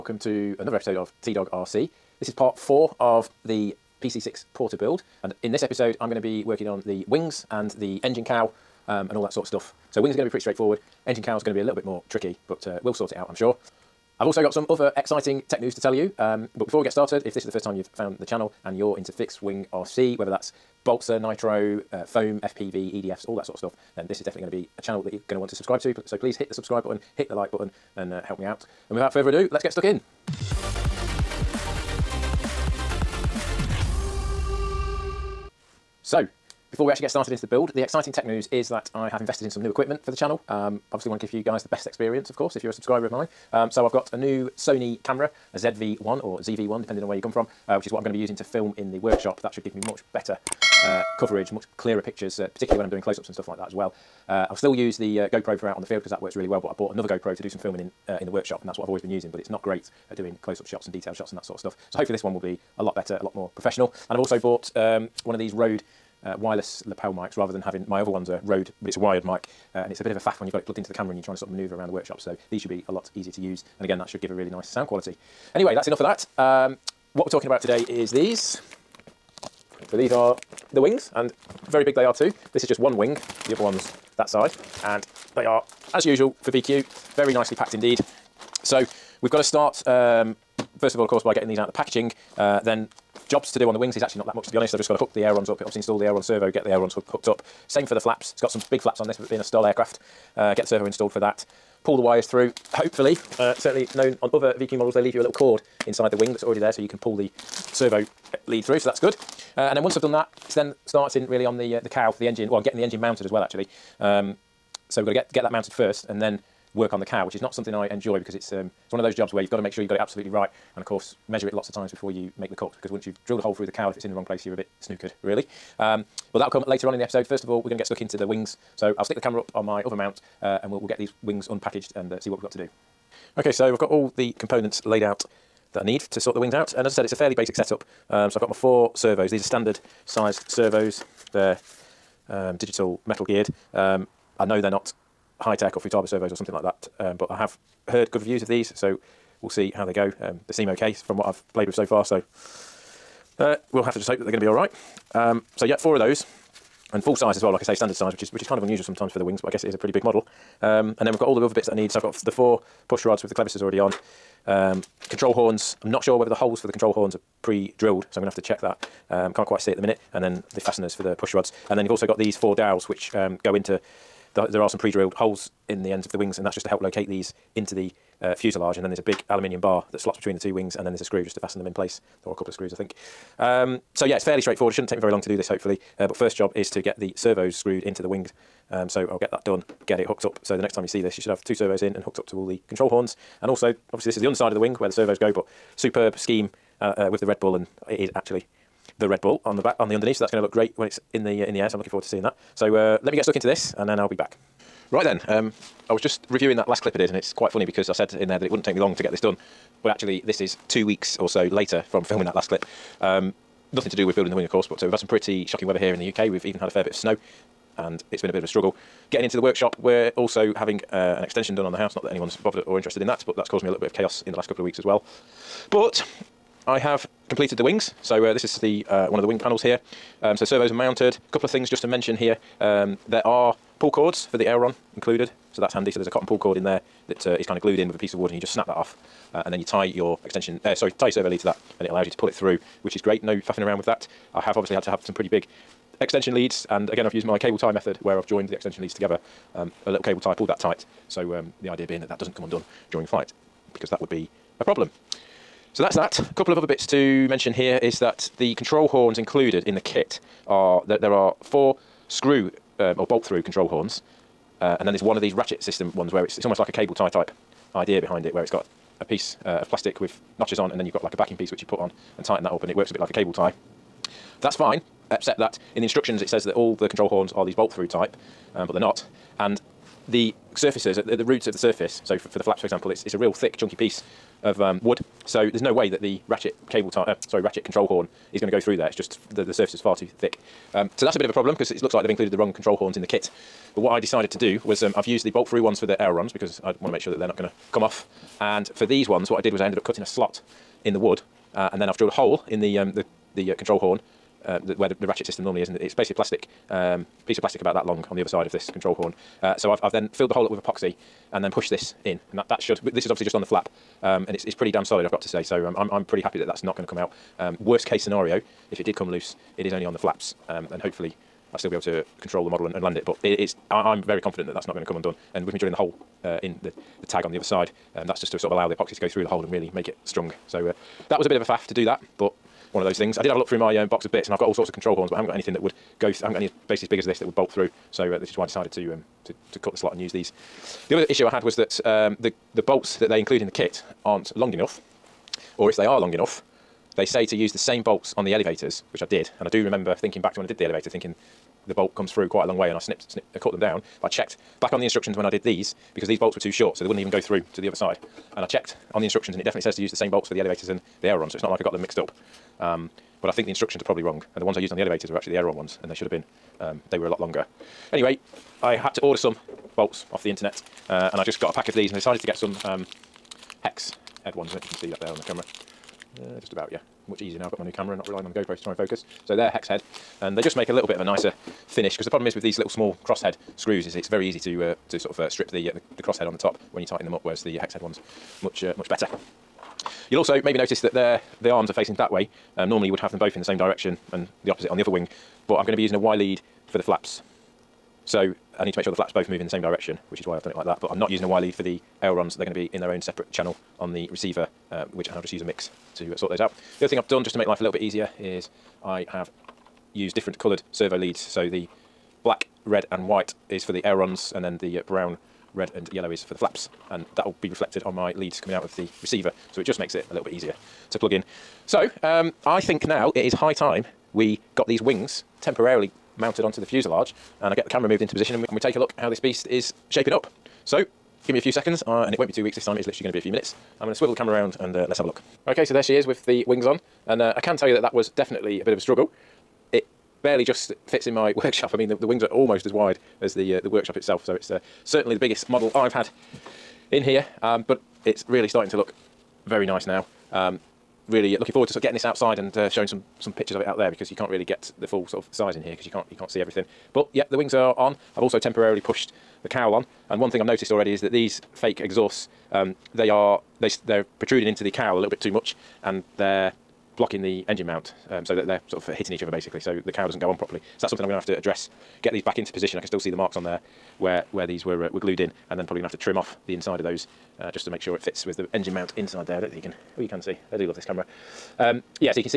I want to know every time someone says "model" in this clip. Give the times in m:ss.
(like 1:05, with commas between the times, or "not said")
1:44, 2:40, 5:22, 7:25.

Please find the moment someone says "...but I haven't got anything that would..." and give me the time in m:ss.
5:35.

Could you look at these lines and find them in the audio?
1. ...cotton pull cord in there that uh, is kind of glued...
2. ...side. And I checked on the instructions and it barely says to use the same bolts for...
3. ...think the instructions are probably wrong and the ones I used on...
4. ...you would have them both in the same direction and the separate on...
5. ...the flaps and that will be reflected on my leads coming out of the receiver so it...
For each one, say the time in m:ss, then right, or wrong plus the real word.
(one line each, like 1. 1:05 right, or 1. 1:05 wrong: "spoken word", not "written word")
1. 3:56 right
2. 5:57 wrong: "definitely", not "barely"
3. 6:03 right
4. 6:32 wrong: "opposite", not "separate"
5. 6:56 right.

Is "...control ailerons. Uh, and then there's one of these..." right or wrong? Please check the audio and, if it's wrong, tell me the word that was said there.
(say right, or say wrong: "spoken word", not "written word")
wrong: "horns", not "ailerons".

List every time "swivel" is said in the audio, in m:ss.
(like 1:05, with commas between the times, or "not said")
7:13.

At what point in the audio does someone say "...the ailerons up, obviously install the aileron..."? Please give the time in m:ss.
1:35.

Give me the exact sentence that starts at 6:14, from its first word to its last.
I don't know if you can see that there on the camera.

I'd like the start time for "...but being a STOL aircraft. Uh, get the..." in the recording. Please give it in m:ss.
1:39.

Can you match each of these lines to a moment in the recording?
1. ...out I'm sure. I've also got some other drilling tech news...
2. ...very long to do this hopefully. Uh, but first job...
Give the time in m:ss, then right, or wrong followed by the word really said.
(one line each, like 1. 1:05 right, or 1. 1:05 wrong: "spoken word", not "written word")
1. 0:13 wrong: "exciting", not "drilling"
2. 3:04 right.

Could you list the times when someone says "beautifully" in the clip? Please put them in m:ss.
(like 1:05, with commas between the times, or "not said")
not said.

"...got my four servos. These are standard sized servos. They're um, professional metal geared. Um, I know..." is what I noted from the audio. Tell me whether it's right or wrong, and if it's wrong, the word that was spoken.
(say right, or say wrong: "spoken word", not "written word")
wrong: "digital", not "professional".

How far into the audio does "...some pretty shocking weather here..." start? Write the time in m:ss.
3:34.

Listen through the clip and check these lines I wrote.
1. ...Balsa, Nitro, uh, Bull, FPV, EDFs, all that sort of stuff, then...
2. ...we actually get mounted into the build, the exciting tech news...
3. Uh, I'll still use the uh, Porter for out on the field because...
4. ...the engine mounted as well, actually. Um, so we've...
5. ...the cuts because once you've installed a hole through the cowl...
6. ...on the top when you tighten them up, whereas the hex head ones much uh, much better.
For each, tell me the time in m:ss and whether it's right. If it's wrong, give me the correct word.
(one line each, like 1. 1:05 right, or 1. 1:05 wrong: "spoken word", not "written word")
1. 0:20 wrong: "Foam", not "Bull"
2. 0:36 wrong: "started", not "mounted"
3. 0:54 wrong: "GoPro", not "Porter"
4. 1:52 right
5. 2:02 wrong: "drilled", not "installed"
6. 6:26 right.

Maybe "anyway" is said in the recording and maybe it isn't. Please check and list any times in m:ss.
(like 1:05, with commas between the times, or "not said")
1:15, 6:07.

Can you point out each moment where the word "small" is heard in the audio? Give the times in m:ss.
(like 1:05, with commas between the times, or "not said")
6:22.